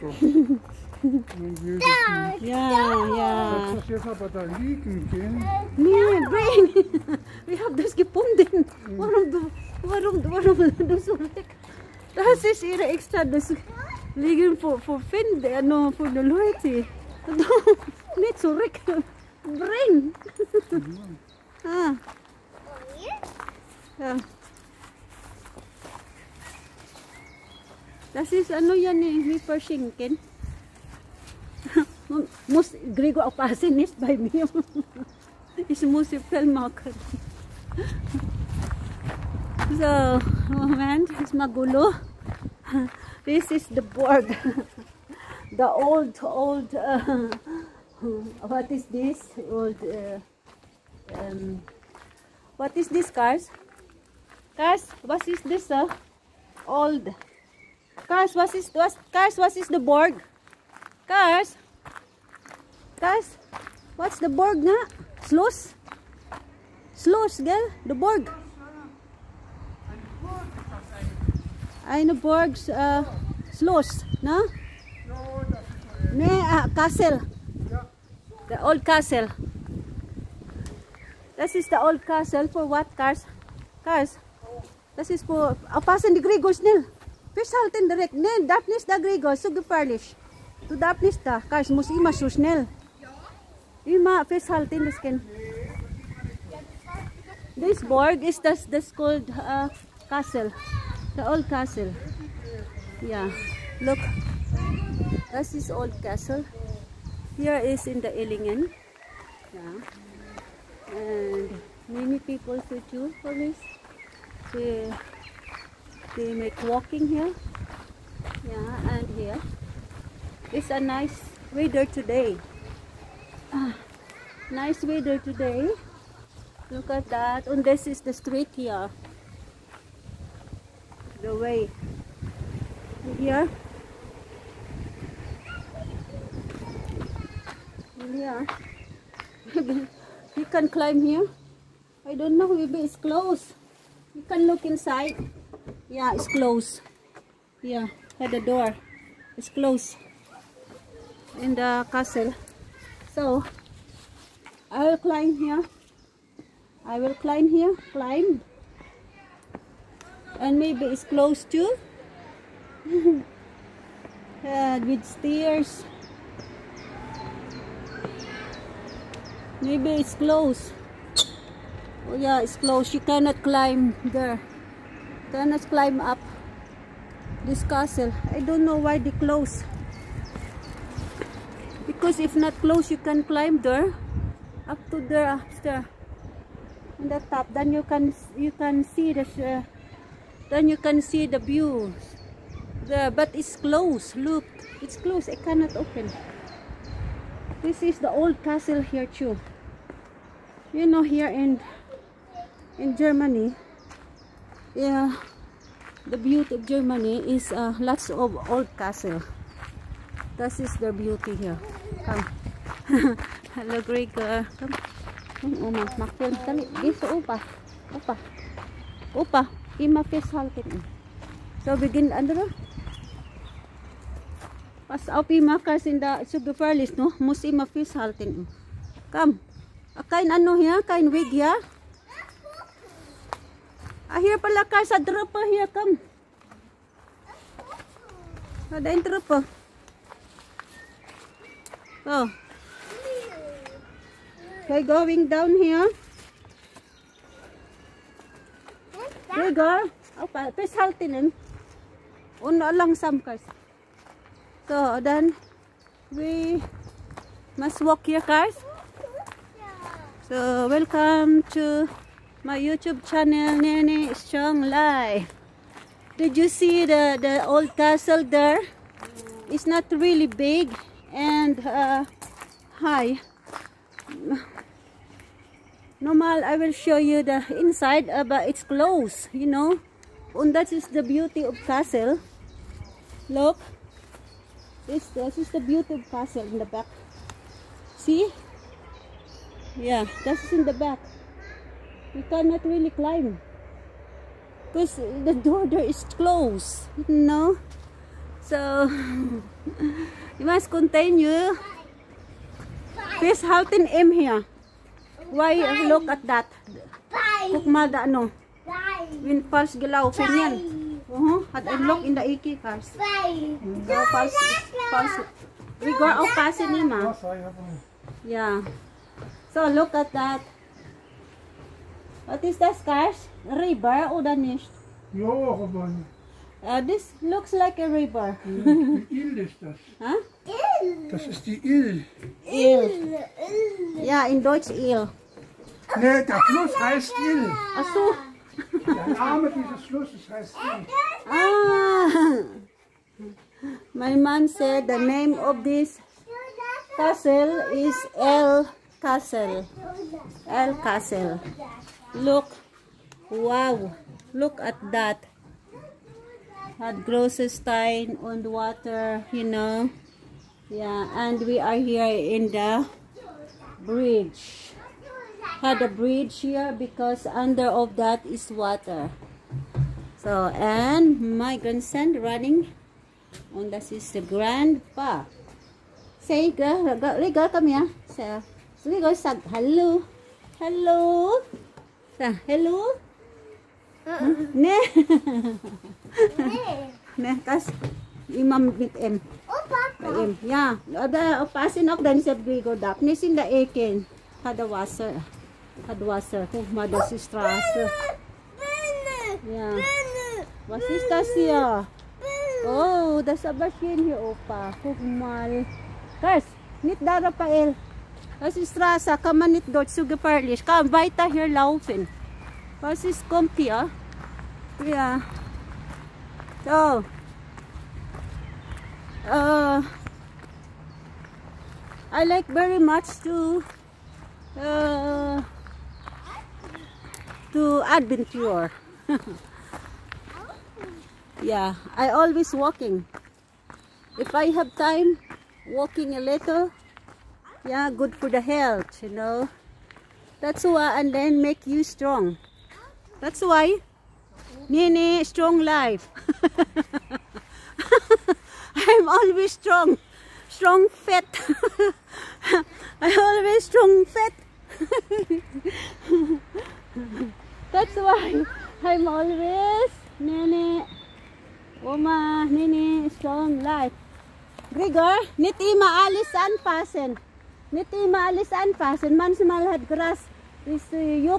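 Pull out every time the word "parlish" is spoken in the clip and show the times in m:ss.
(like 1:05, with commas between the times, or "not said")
1:29.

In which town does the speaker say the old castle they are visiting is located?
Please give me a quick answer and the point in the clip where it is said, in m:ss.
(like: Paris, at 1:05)
Illingen, at 1:48.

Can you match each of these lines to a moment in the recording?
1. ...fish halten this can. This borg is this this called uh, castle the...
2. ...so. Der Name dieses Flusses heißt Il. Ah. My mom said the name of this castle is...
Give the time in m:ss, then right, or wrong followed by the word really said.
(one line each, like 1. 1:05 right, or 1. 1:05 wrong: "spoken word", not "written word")
1. 1:34 right
2. 5:37 right.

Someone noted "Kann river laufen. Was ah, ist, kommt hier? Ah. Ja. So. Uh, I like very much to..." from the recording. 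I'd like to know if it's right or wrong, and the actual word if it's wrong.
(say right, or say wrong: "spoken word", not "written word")
wrong: "weiter", not "river".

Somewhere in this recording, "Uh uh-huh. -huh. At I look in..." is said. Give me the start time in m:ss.
5:11.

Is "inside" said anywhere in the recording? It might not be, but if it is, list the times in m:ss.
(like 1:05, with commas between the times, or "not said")
2:24, 4:37.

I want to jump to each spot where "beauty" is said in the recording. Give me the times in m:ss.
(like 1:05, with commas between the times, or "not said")
3:26, 3:30, 4:41, 4:45.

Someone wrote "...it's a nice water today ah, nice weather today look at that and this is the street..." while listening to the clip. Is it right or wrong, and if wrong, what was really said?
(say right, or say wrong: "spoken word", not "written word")
wrong: "weather", not "water".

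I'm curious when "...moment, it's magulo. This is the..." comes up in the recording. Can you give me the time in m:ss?
0:40.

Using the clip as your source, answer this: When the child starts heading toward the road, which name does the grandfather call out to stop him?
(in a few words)
Raphael.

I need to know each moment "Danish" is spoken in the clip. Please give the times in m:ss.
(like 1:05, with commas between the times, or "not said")
5:24.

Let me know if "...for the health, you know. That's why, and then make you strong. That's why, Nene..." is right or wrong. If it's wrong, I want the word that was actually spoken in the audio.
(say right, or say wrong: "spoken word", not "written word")
right.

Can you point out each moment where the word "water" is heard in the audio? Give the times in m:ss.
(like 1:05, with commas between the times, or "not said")
5:58, 6:08, 6:34.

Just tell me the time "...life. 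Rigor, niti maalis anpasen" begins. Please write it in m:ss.
7:43.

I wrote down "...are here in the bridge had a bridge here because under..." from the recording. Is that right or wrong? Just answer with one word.
right.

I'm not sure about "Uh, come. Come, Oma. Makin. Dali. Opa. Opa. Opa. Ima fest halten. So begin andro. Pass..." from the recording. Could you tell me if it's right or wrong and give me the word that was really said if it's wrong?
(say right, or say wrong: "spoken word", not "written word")
right.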